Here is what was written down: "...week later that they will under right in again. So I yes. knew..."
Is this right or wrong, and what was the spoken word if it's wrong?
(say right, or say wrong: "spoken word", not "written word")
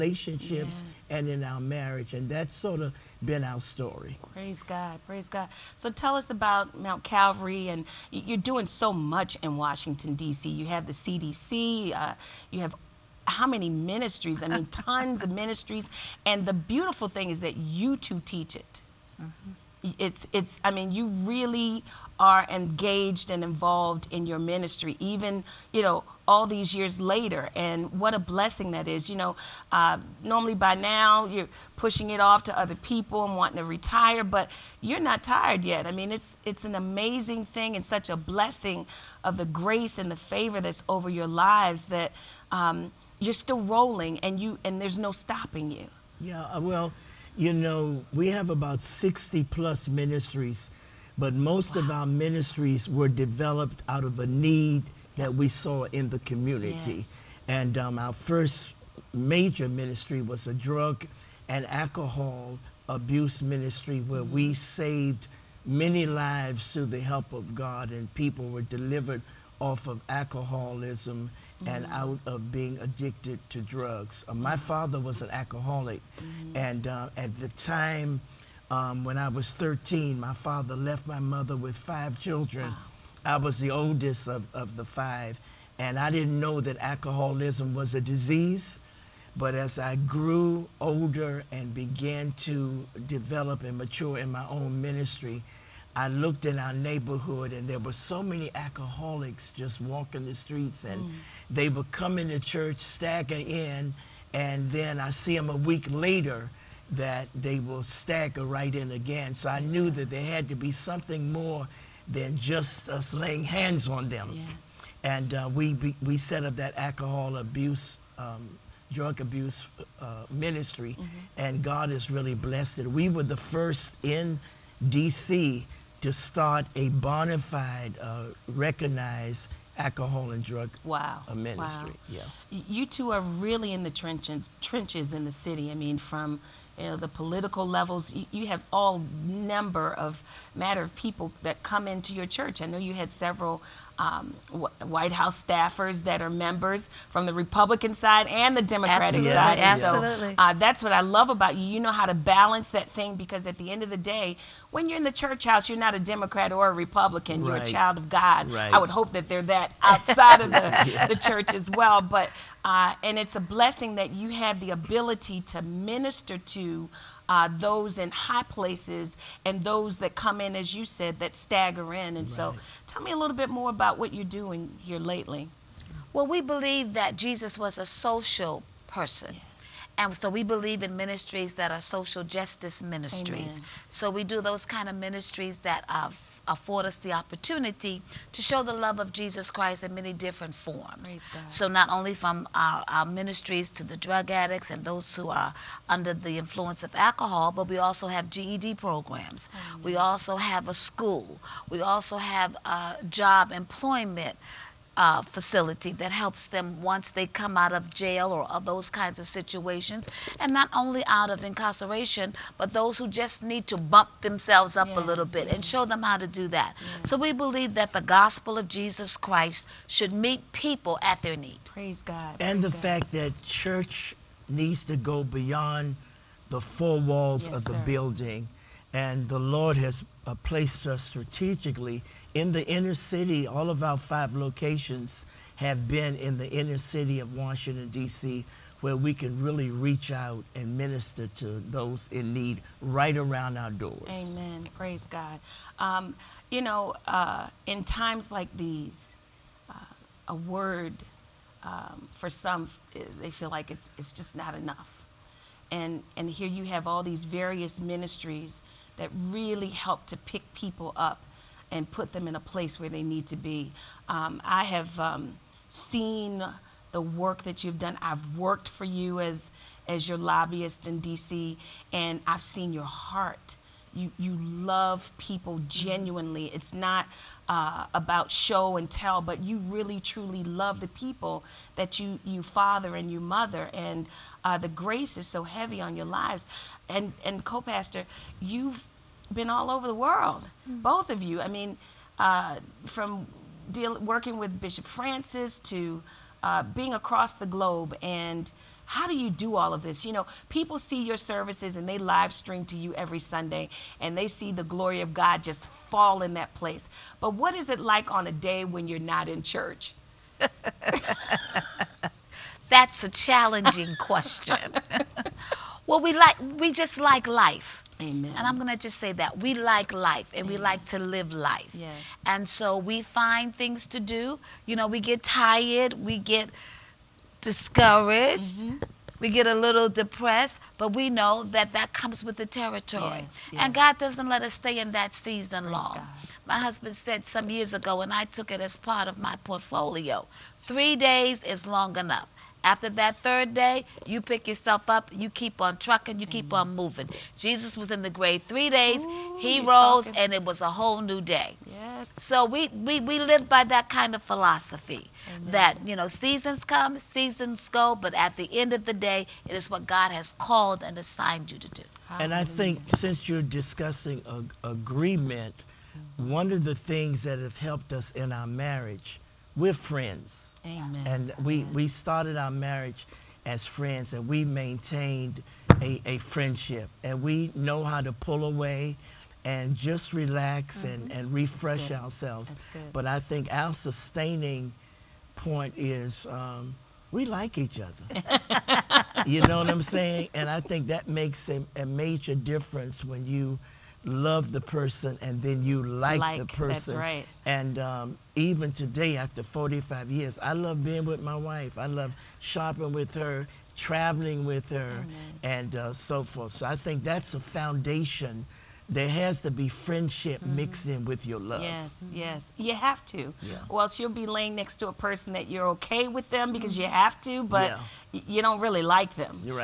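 wrong: "stagger", not "under".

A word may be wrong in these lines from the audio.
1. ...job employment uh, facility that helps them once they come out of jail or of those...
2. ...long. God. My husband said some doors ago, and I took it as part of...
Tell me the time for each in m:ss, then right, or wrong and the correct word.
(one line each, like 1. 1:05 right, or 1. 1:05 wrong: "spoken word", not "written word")
1. 3:23 right
2. 5:35 wrong: "years", not "doors".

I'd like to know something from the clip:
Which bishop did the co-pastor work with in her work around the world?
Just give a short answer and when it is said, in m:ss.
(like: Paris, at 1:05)
Bishop Francis, at 4:54.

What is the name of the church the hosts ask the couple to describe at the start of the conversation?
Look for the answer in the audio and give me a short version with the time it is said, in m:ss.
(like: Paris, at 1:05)
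Mount Calvary, at 0:06.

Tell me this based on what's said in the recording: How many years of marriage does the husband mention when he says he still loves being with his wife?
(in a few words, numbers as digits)
45.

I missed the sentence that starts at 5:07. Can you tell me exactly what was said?
But what is it like on a day when you're not in church?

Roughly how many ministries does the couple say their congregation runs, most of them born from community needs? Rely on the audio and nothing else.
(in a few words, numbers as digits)
60 plus.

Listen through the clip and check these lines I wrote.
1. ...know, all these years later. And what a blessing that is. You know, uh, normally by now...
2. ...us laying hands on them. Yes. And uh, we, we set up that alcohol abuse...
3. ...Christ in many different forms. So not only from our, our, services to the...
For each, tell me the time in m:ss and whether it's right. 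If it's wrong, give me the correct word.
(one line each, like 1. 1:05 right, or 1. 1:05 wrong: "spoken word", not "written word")
1. 0:25 right
2. 1:52 right
3. 3:09 wrong: "ministries", not "services".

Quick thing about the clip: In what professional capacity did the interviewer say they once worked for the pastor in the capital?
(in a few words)
Lobbyist.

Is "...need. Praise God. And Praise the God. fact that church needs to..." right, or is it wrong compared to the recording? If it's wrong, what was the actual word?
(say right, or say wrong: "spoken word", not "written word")
right.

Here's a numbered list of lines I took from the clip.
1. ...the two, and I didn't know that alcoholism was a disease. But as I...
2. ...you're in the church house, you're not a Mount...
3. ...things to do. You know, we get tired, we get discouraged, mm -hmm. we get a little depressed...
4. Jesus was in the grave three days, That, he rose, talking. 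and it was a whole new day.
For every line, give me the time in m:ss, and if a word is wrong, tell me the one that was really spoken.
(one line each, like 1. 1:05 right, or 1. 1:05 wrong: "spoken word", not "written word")
1. 1:24 wrong: "five", not "two"
2. 2:34 wrong: "Democrat", not "Mount"
3. 5:23 right
4. 5:47 wrong: "Ooh", not "That".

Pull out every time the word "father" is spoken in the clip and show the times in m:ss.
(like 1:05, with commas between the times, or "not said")
1:14, 1:20, 4:42.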